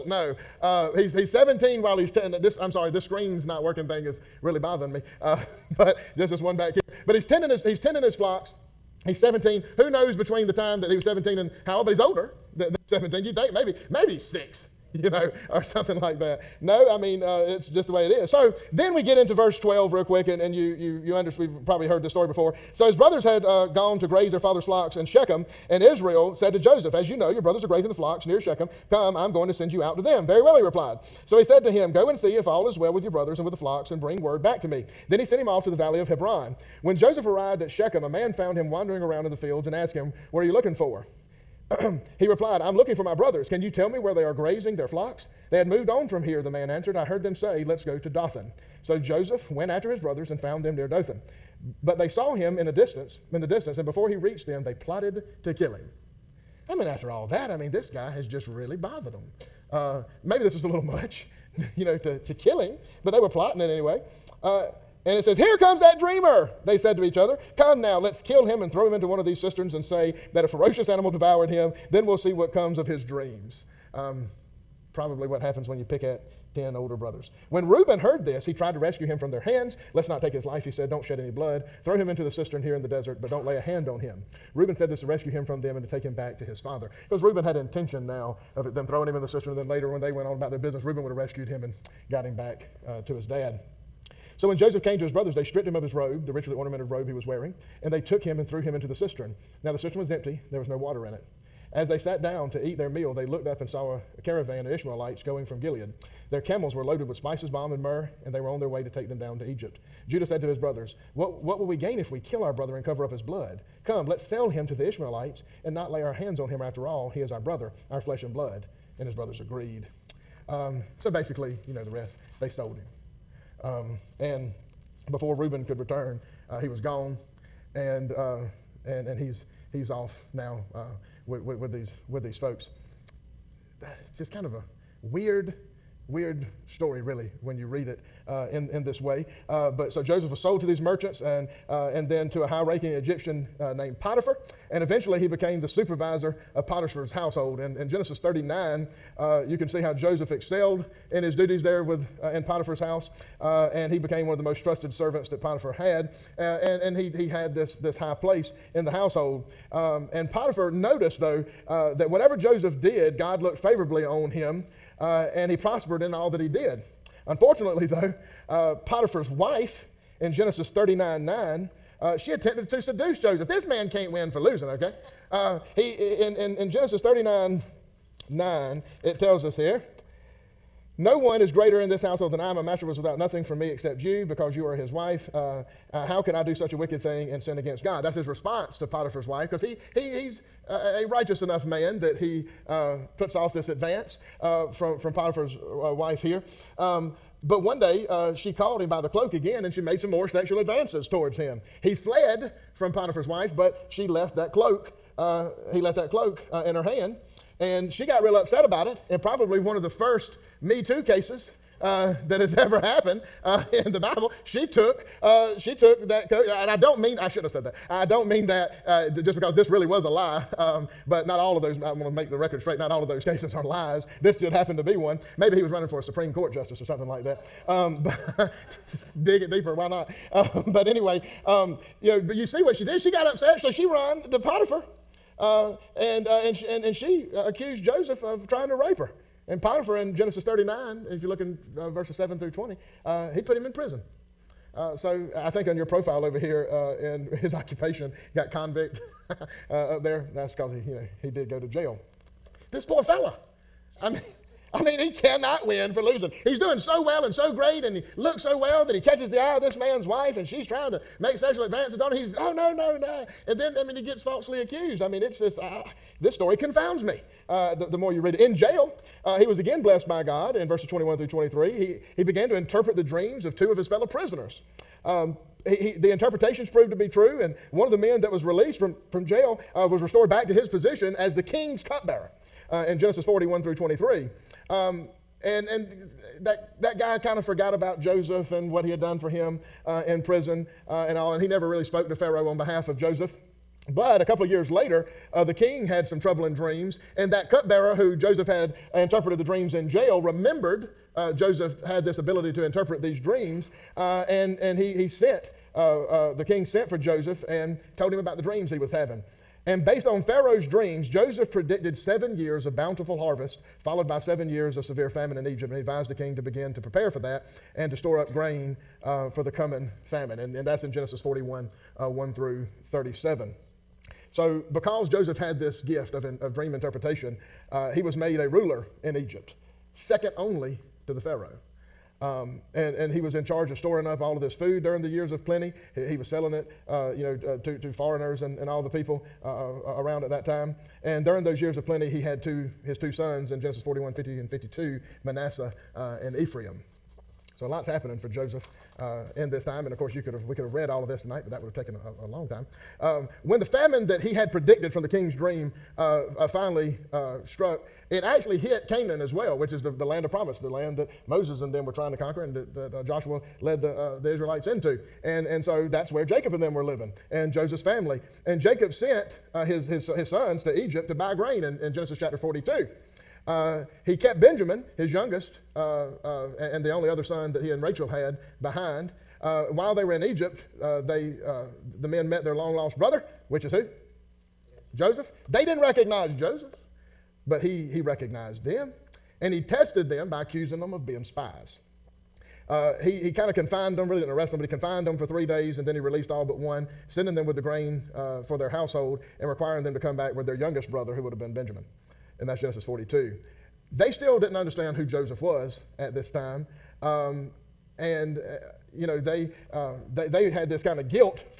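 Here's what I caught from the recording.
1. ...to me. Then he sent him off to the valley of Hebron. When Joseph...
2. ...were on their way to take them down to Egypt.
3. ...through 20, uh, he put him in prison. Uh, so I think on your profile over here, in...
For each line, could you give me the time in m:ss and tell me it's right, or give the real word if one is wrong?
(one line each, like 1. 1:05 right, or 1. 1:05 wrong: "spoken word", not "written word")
1. 0:34 right
2. 1:48 right
3. 4:02 right.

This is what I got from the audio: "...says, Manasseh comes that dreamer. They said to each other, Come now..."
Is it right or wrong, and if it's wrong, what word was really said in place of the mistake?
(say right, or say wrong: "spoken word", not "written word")
wrong: "Here", not "Manasseh".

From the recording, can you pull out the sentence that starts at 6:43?
They still didn't understand who Joseph was at this time.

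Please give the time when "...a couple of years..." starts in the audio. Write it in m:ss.
4:54.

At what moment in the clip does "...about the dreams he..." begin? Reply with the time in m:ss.
5:08.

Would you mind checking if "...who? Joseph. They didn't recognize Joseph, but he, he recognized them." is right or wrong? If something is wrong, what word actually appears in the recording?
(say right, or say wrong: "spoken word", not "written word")
right.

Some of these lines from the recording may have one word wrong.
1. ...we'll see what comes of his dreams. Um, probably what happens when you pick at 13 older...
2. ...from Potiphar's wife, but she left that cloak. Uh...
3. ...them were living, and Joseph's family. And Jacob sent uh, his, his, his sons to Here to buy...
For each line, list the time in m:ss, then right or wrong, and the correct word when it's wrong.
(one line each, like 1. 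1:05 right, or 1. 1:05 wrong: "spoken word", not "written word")
1. 1:12 wrong: "10", not "13"
2. 3:22 right
3. 6:06 wrong: "Egypt", not "Here".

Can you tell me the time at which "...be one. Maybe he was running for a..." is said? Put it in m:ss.
3:44.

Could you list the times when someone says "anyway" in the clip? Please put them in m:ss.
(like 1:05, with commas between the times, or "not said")
1:03, 3:50.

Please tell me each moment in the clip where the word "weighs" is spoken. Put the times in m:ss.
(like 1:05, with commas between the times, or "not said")
not said.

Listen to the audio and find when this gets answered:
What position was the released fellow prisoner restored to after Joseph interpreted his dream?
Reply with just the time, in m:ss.
4:41.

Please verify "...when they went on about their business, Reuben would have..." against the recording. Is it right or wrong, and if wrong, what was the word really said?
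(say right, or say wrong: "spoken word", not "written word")
right.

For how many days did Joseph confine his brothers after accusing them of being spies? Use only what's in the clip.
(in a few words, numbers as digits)
3.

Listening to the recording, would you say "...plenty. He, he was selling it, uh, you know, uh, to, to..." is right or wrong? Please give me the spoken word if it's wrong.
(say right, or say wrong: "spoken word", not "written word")
right.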